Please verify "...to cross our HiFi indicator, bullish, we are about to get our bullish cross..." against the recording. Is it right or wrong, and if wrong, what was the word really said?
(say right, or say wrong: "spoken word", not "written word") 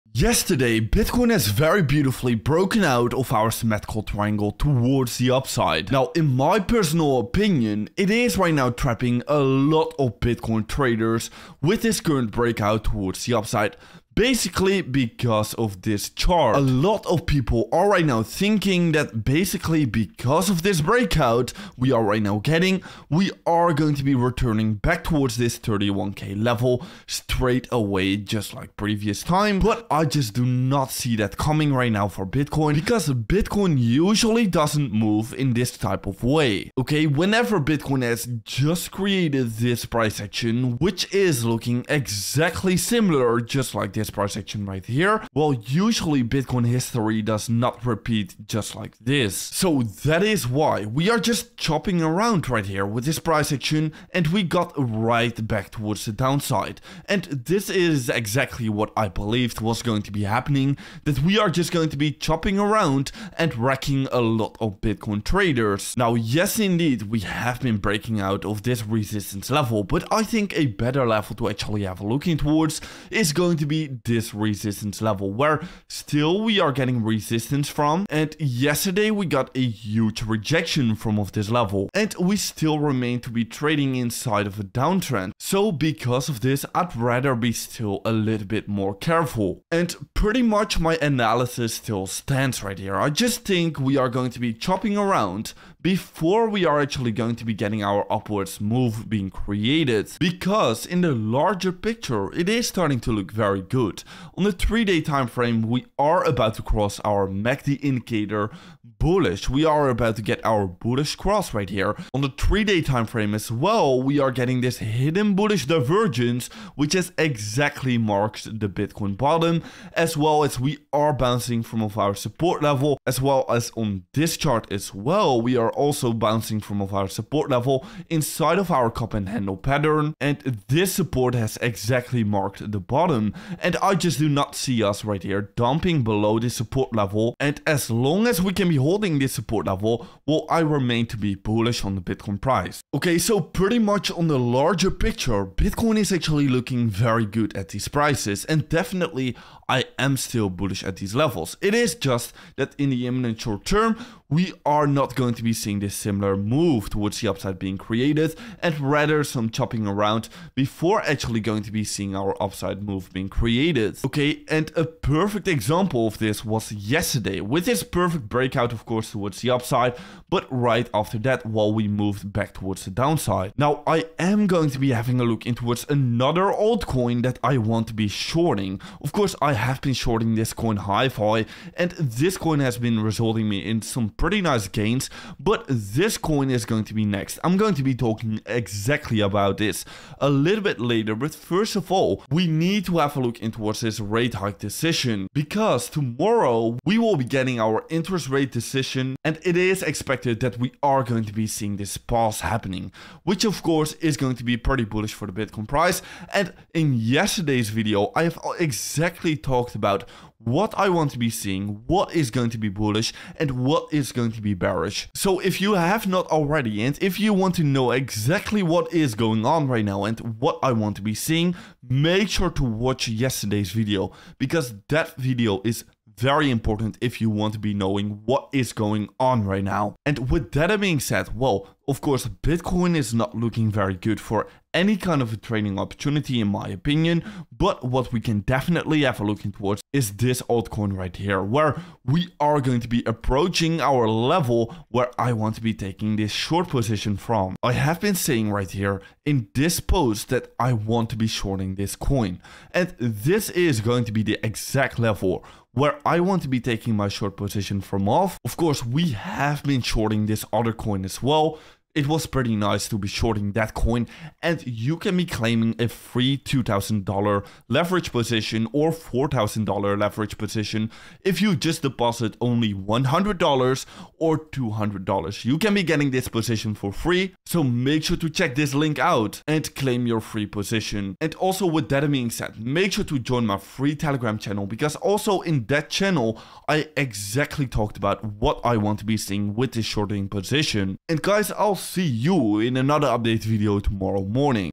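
wrong: "MACD", not "HiFi".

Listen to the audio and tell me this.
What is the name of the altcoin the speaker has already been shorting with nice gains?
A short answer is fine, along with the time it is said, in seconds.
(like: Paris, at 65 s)
HiFi, at 180 s.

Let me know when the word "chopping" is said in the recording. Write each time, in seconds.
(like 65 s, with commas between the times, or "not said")
51 s, 62 s, 94 s, 159 s.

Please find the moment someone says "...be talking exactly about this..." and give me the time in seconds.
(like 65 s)
187 s.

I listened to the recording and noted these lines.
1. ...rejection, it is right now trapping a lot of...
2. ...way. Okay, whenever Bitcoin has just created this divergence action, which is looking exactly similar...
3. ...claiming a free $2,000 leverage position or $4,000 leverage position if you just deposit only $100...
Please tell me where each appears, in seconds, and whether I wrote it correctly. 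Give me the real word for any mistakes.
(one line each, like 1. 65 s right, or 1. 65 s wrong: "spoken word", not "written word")
1. 7 s wrong: "opinion", not "rejection"
2. 36 s wrong: "price", not "divergence"
3. 265 s right.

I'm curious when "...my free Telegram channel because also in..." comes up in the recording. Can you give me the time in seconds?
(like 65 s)
283 s.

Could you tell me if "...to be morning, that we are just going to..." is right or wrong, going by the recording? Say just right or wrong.
wrong.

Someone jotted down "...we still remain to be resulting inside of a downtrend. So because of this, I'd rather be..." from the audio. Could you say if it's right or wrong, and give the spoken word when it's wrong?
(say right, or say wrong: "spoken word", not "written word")
wrong: "trading", not "resulting".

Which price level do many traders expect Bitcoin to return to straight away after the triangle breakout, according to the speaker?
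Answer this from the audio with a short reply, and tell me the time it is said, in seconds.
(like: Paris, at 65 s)
31k, at 25 s.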